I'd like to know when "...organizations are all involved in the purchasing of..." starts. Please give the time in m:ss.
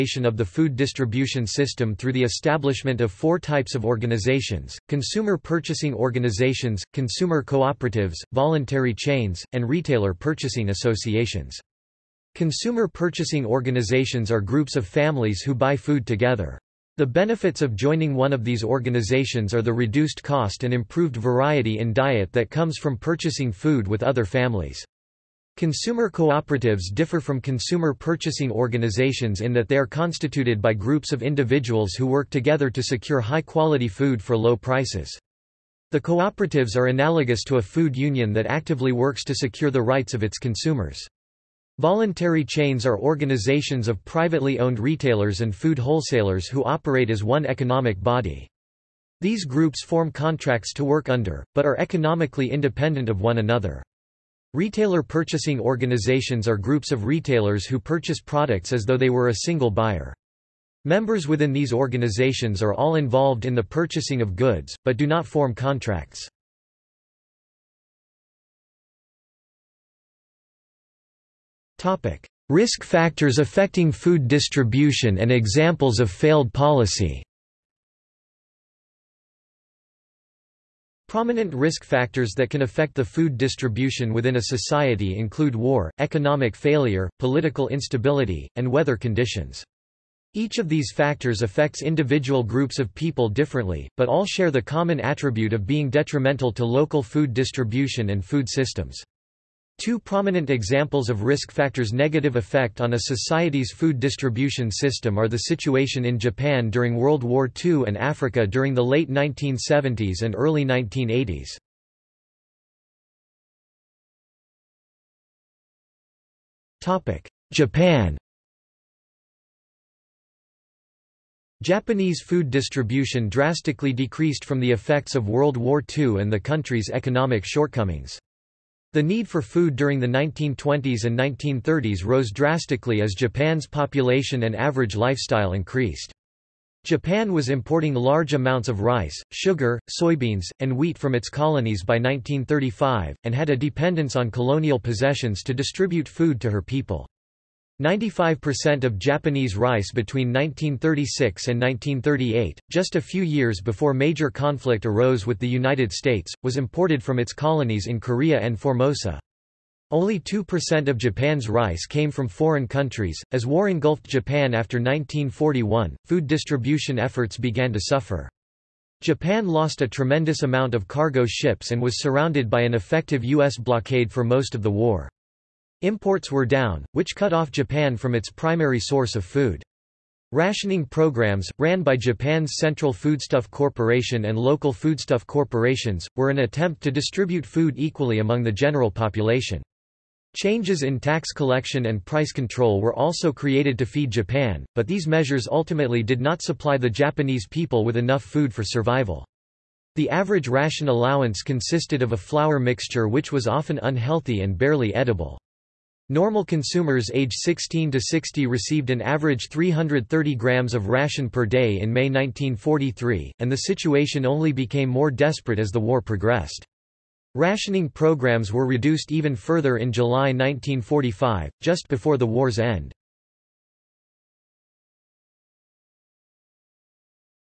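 1:01.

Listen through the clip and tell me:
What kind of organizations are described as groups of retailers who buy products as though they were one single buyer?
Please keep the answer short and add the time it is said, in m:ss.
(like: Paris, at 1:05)
Retailer purchasing organizations, at 0:54.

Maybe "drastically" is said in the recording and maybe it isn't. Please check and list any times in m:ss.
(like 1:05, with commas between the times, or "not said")
2:03, 2:12.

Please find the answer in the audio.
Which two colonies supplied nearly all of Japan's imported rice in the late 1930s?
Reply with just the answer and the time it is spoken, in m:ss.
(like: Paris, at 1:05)
Korea and Formosa, at 2:37.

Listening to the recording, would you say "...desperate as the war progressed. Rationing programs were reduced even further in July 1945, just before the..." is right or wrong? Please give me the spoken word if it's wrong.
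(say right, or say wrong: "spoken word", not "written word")
right.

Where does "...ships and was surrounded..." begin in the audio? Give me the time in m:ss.
2:51.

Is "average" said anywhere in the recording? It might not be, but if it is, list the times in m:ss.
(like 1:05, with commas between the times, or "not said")
2:14, 3:20, 3:28.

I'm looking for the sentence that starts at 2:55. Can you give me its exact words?
Imports were down, which cut off Japan from its primary source of food.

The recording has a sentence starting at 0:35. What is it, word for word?
The cooperatives are analogous to a food union that actively works to secure the rights of its consumers.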